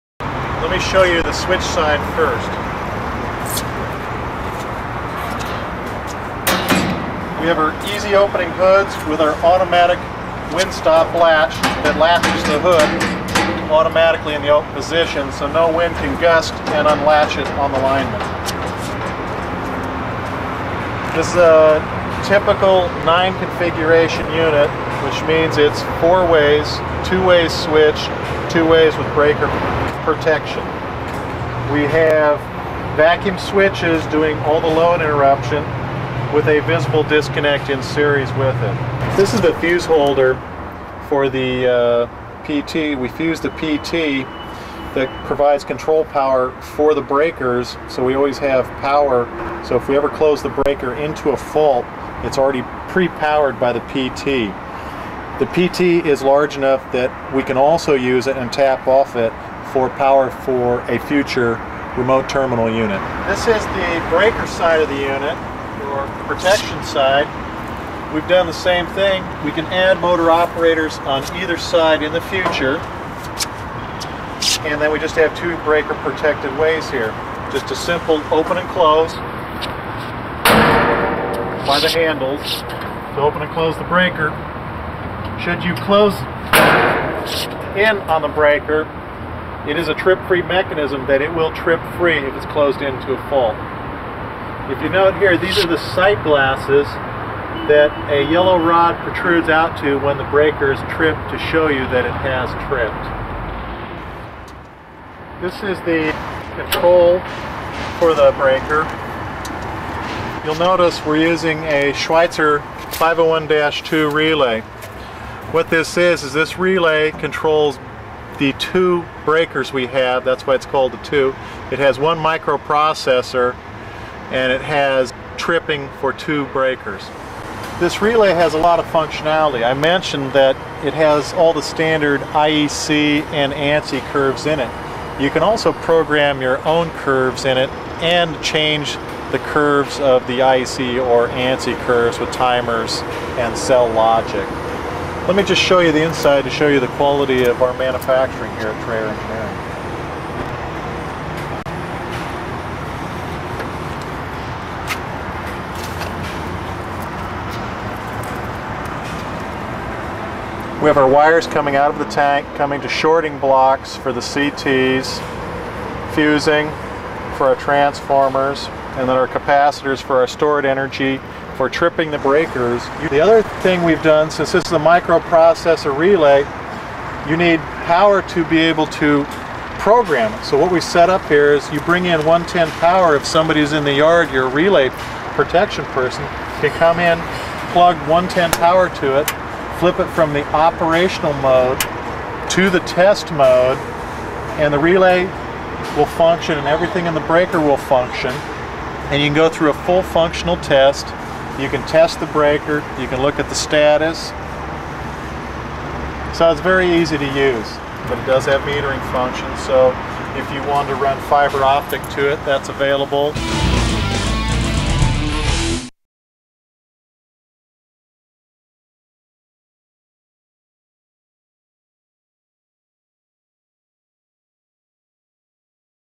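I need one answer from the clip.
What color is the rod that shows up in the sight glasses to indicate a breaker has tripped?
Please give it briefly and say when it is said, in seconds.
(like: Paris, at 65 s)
yellow, at 98 s.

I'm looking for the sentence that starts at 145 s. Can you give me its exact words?
Let me just show you the inside to show you the quality of our manufacturing here at Trayer Engineering.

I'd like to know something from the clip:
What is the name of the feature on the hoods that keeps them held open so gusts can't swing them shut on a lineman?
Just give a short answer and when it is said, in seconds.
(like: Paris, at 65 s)
automatic wind stop latch, at 9 s.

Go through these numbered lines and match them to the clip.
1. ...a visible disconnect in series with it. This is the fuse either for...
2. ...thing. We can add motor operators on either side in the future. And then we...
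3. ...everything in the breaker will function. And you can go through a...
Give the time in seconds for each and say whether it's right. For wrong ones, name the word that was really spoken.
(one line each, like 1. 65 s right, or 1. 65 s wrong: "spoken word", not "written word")
1. 36 s wrong: "holder", not "either"
2. 68 s right
3. 196 s right.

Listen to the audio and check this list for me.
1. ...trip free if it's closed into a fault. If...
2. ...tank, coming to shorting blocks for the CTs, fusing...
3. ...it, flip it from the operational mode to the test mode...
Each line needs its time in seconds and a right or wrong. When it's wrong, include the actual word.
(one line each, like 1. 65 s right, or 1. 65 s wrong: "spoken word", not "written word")
1. 91 s right
2. 162 s right
3. 189 s right.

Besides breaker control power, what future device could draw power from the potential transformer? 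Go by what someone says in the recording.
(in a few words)
remote terminal unit.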